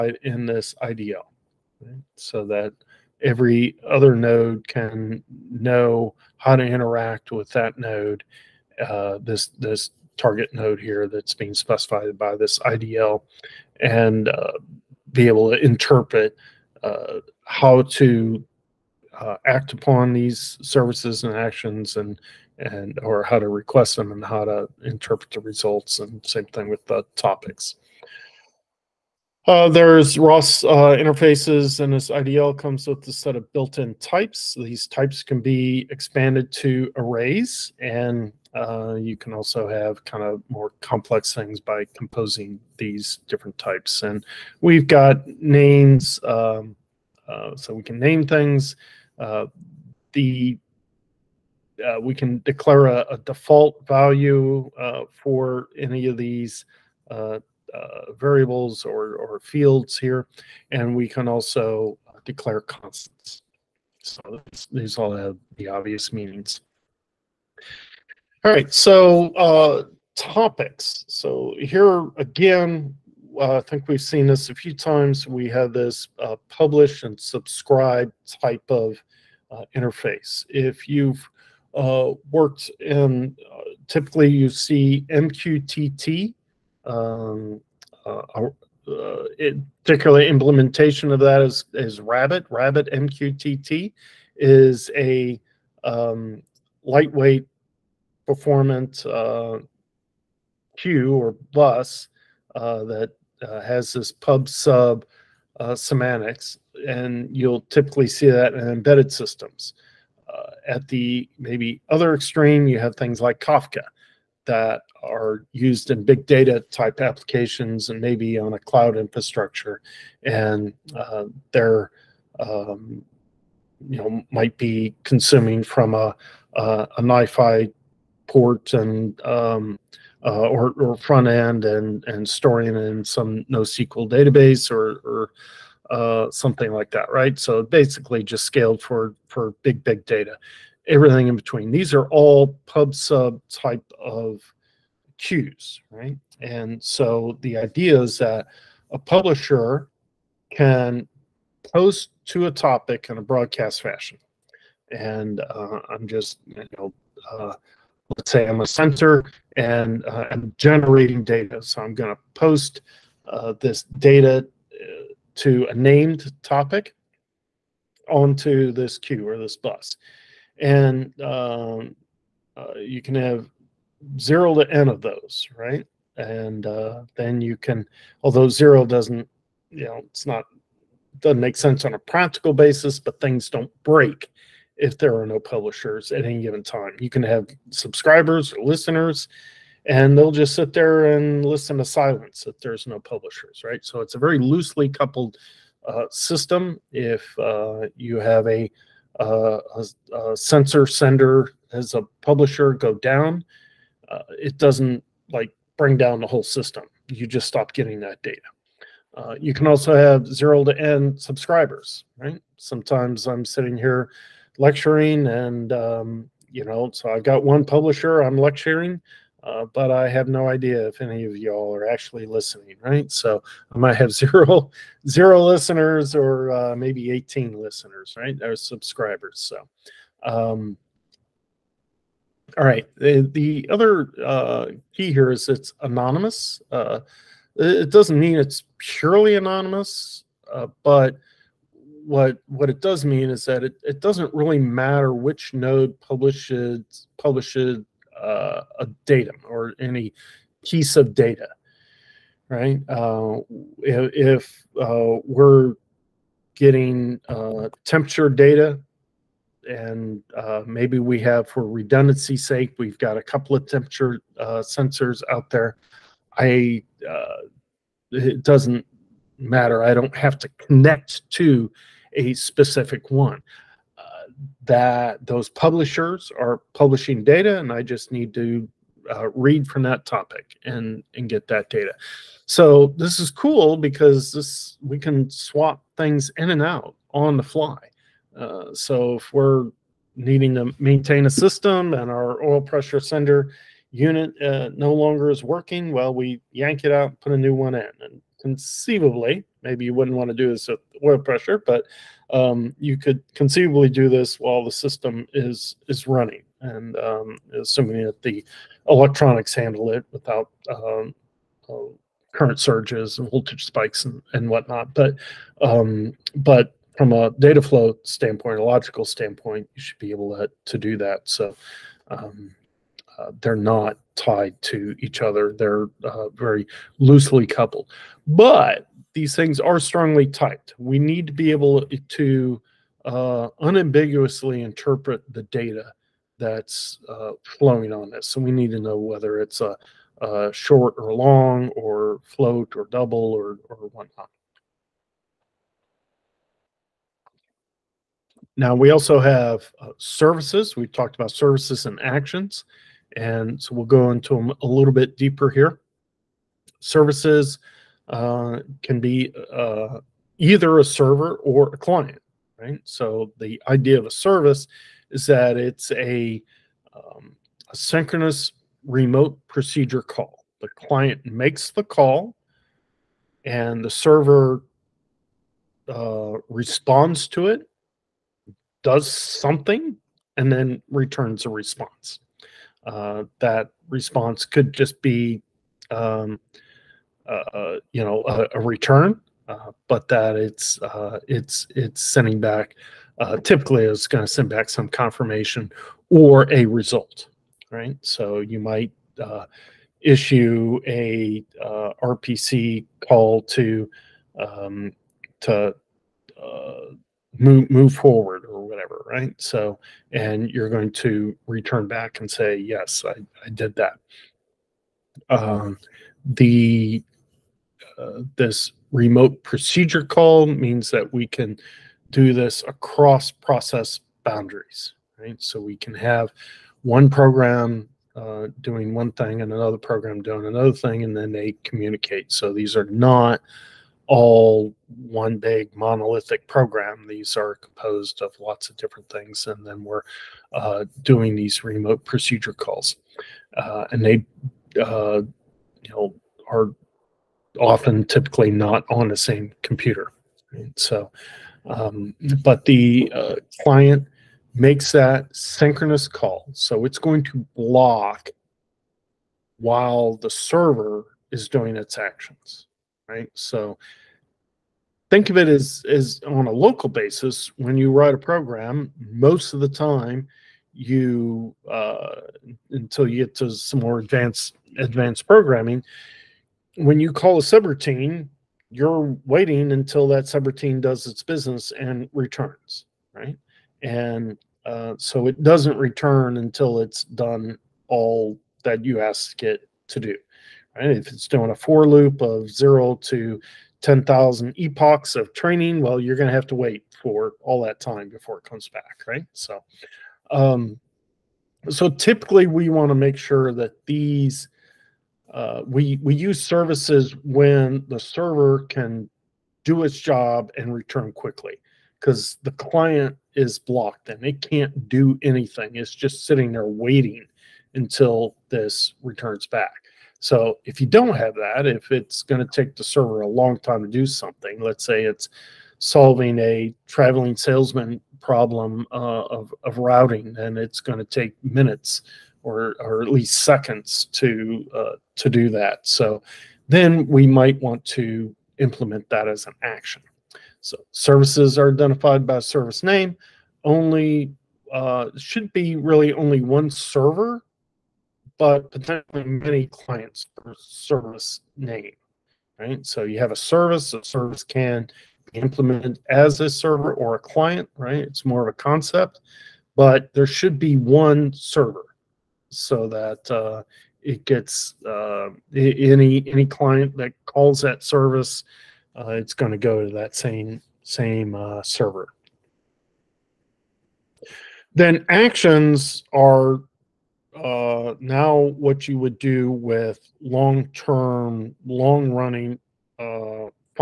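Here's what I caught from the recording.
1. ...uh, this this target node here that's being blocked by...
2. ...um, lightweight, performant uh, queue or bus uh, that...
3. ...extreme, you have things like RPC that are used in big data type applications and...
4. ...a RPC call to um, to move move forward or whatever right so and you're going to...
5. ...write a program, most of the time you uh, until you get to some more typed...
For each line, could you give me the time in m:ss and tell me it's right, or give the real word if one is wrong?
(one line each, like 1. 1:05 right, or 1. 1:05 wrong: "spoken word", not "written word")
1. 0:08 wrong: "specified", not "blocked"
2. 1:35 right
3. 1:52 wrong: "Kafka", not "RPC"
4. 6:40 right
5. 7:47 wrong: "advanced", not "typed".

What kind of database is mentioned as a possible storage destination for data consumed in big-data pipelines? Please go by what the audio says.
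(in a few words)
NoSQL.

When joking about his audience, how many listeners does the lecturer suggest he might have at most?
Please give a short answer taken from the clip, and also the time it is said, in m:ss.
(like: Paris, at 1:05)
18, at 3:47.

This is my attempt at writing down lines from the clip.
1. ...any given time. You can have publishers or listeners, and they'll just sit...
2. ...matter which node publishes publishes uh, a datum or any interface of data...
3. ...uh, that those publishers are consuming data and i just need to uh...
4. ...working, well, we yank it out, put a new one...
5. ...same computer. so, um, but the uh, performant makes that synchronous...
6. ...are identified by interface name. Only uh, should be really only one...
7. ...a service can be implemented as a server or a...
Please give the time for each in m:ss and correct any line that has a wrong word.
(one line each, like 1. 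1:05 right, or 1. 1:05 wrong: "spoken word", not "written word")
1. 3:06 wrong: "subscribers", not "publishers"
2. 4:04 wrong: "piece", not "interface"
3. 4:33 wrong: "publishing", not "consuming"
4. 4:55 right
5. 7:29 wrong: "client", not "performant"
6. 9:01 wrong: "service", not "interface"
7. 9:13 right.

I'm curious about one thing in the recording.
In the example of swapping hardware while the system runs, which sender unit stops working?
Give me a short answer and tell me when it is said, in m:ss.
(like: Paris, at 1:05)
oil pressure sender unit, at 4:52.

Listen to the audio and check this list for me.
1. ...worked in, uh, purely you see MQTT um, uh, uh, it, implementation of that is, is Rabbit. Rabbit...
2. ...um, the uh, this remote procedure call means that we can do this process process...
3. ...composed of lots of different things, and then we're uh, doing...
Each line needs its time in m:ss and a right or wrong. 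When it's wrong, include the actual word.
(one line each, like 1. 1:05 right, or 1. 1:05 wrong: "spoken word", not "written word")
1. 1:22 wrong: "typically", not "purely"
2. 6:55 wrong: "across", not "process"
3. 7:17 right.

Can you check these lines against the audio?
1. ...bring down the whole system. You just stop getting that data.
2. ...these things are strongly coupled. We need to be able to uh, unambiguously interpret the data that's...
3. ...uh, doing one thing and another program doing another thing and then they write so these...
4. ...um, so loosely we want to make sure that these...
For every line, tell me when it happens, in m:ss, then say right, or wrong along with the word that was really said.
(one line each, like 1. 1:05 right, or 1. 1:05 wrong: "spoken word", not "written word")
1. 3:25 right
2. 5:29 wrong: "typed", not "coupled"
3. 7:08 wrong: "communicate", not "write"
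4. 8:20 wrong: "typically", not "loosely".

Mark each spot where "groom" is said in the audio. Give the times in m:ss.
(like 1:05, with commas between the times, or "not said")
not said.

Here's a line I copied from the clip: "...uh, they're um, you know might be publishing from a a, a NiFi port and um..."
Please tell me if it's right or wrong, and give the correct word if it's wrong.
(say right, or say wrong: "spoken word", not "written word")
wrong: "consuming", not "publishing".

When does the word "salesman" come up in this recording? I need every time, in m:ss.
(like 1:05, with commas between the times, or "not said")
8:47.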